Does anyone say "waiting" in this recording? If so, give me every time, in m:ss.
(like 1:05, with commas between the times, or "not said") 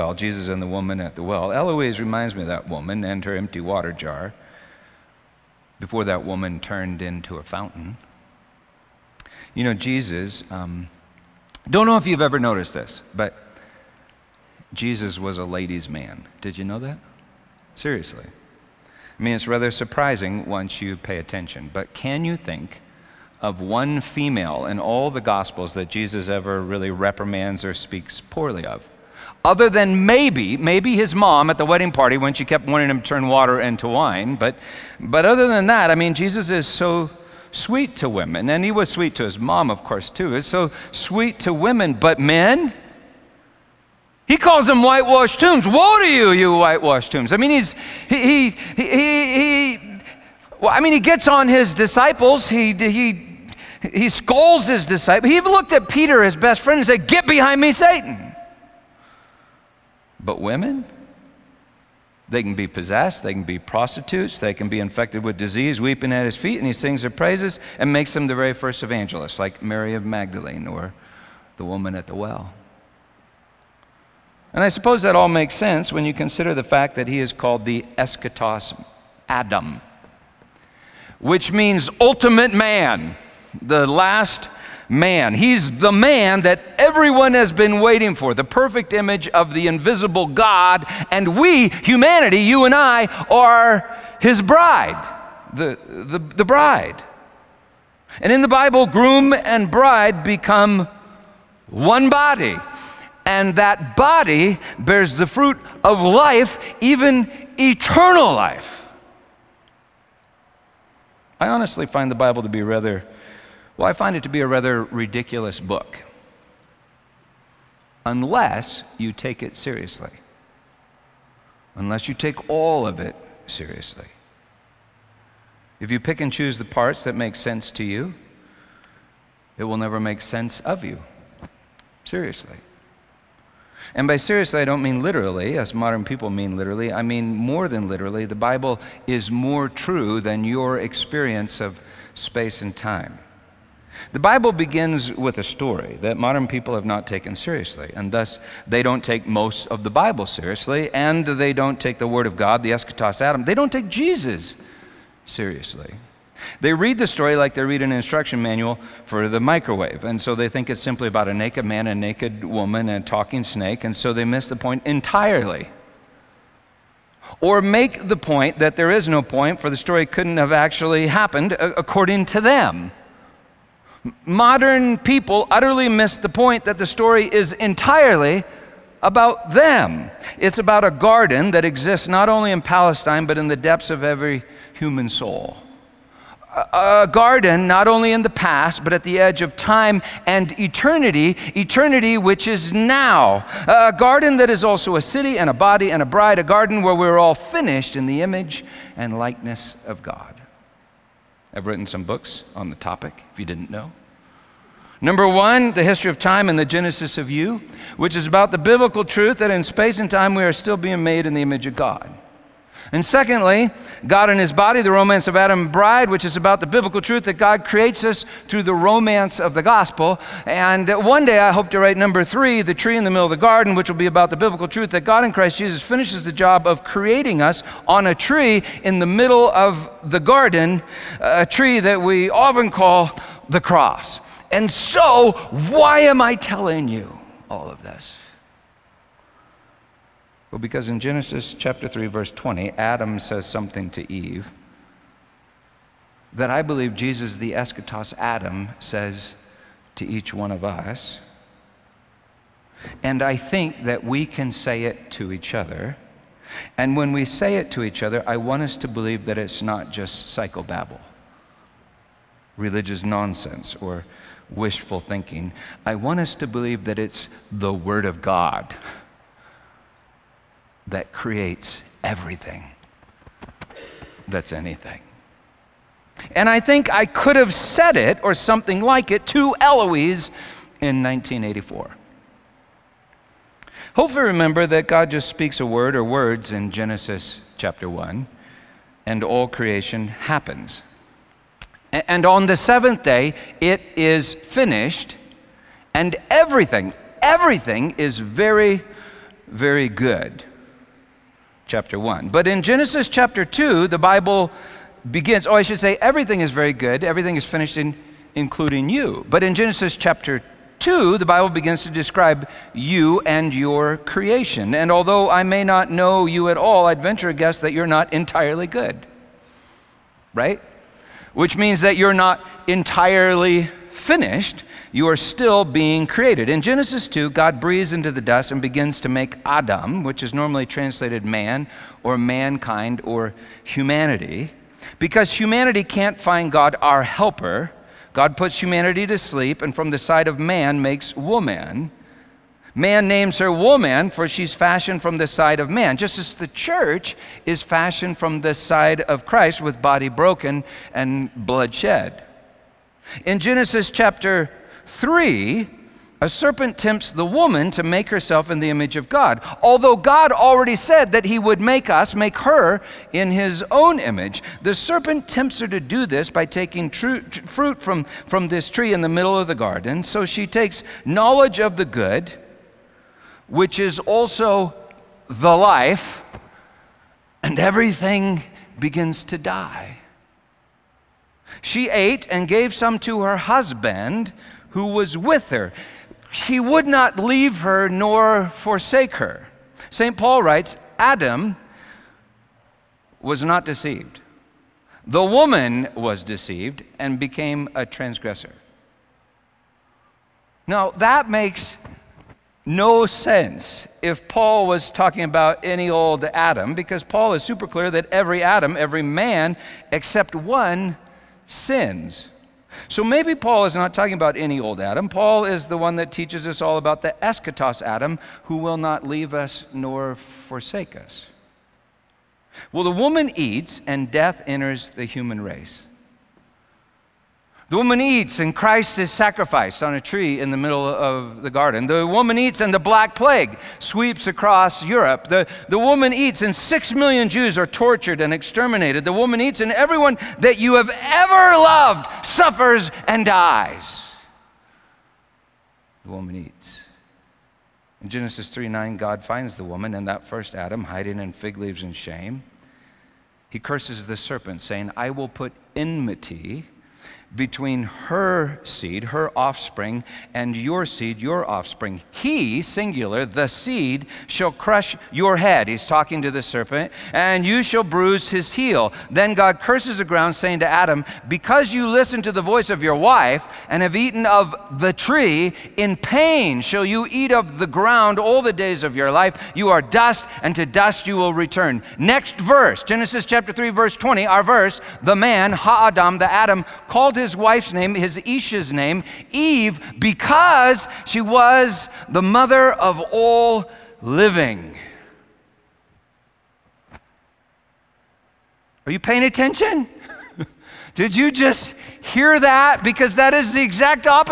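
1:27.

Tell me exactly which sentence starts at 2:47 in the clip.
Or make the point that there is no point, for the story couldn't have actually happened according to them.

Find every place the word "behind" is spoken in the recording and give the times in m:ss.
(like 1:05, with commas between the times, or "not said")
0:57.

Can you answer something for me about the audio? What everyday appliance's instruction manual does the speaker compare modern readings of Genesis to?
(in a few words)
microwave.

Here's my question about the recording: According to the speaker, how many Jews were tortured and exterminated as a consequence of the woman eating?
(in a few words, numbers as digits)
6 million.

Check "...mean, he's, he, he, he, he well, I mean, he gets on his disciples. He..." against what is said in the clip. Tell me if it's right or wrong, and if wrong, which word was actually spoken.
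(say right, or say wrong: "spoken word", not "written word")
right.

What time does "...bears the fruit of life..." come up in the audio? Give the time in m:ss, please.
1:44.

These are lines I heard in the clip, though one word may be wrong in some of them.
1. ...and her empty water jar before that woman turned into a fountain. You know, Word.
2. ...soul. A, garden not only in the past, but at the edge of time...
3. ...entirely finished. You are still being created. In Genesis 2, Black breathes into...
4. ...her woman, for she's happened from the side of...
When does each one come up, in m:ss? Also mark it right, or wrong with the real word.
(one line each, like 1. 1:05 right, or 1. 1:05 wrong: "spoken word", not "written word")
1. 0:03 wrong: "Jesus", not "Word"
2. 3:05 right
3. 5:22 wrong: "God", not "Black"
4. 5:43 wrong: "fashioned", not "happened".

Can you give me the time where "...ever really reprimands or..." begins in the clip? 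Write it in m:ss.
0:26.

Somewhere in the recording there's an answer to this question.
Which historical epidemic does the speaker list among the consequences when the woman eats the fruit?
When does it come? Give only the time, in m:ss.
7:12.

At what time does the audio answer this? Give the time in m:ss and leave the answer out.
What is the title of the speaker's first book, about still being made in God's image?
3:25.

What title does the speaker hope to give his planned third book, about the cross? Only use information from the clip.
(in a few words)
The Tree in the Middle of the Garden.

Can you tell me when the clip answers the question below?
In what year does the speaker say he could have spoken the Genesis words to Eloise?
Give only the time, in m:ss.
4:41.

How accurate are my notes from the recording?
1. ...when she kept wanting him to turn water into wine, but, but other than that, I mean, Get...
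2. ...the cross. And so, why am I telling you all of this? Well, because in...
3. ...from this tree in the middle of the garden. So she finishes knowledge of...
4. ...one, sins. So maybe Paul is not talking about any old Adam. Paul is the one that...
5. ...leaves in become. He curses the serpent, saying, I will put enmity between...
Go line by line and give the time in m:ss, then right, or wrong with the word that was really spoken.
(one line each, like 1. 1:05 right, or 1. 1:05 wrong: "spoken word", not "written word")
1. 0:32 wrong: "Jesus", not "Get"
2. 3:53 right
3. 6:08 wrong: "takes", not "finishes"
4. 6:50 right
5. 7:31 wrong: "shame", not "become".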